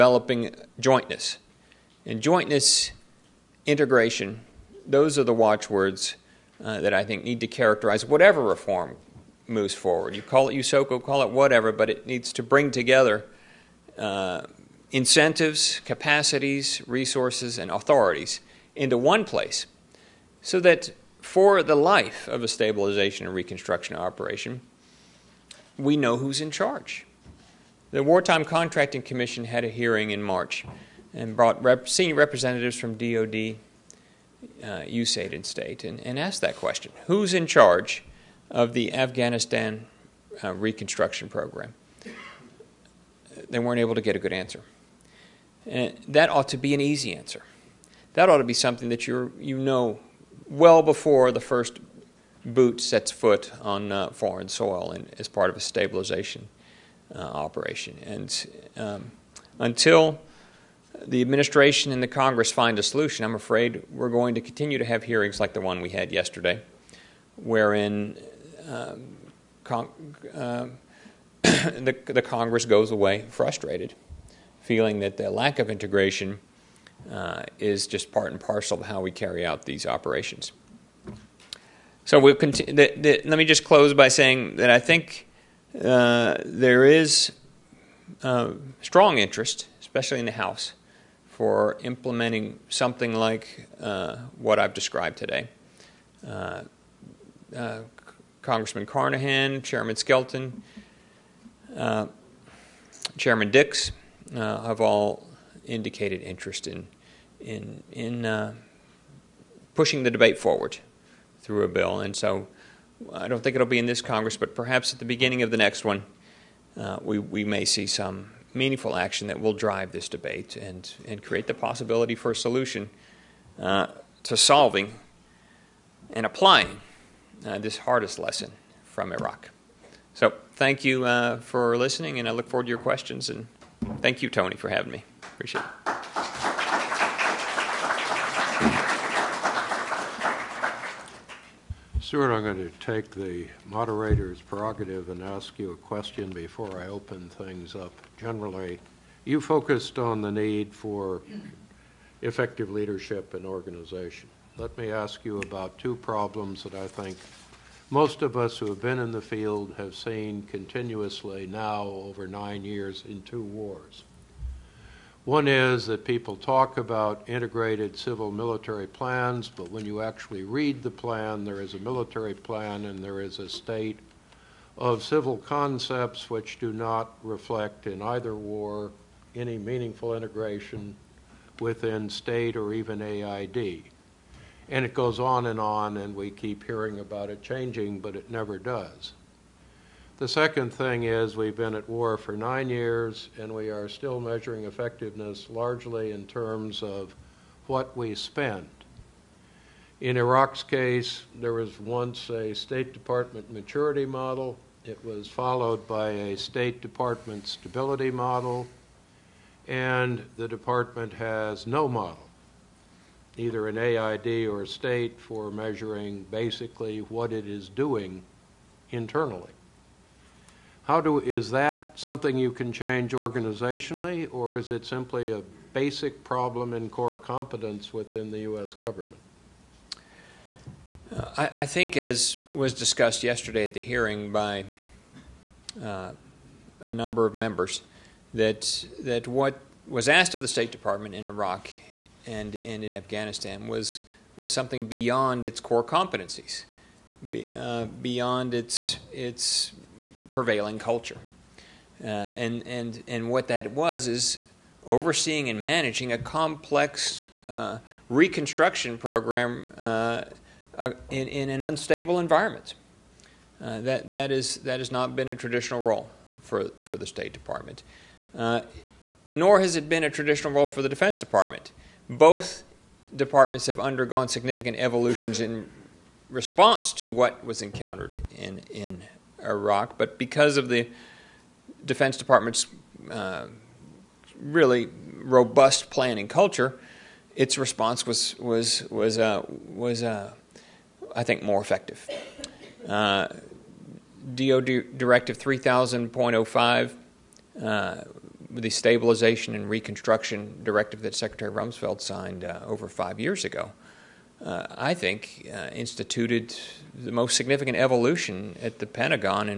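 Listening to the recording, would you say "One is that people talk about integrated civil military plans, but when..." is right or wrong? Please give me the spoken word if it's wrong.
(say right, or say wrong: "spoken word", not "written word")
right.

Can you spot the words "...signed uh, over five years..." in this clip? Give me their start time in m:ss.
5:01.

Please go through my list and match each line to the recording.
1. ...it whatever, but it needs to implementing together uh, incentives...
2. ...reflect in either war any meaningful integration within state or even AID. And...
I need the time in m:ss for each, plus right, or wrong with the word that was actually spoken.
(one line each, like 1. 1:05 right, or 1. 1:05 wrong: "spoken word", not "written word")
1. 0:11 wrong: "bring", not "implementing"
2. 2:57 right.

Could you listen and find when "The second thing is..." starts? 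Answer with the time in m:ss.
3:10.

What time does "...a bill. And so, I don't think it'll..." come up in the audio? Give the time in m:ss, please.
1:51.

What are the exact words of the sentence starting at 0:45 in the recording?
And that ought to be an easy answer.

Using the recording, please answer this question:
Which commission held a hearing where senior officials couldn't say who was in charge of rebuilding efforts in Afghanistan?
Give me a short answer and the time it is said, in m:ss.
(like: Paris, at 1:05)
Wartime Contracting Commission, at 0:28.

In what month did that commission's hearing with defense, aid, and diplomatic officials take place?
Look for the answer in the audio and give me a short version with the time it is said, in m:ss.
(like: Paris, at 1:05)
March, at 0:30.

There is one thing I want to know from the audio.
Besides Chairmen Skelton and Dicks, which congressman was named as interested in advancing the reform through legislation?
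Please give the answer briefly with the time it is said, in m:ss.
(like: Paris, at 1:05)
Carnahan, at 1:38.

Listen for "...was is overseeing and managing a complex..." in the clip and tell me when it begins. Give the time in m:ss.
4:13.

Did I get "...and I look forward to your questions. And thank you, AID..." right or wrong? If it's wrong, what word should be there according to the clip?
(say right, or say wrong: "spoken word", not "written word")
wrong: "Tony", not "AID".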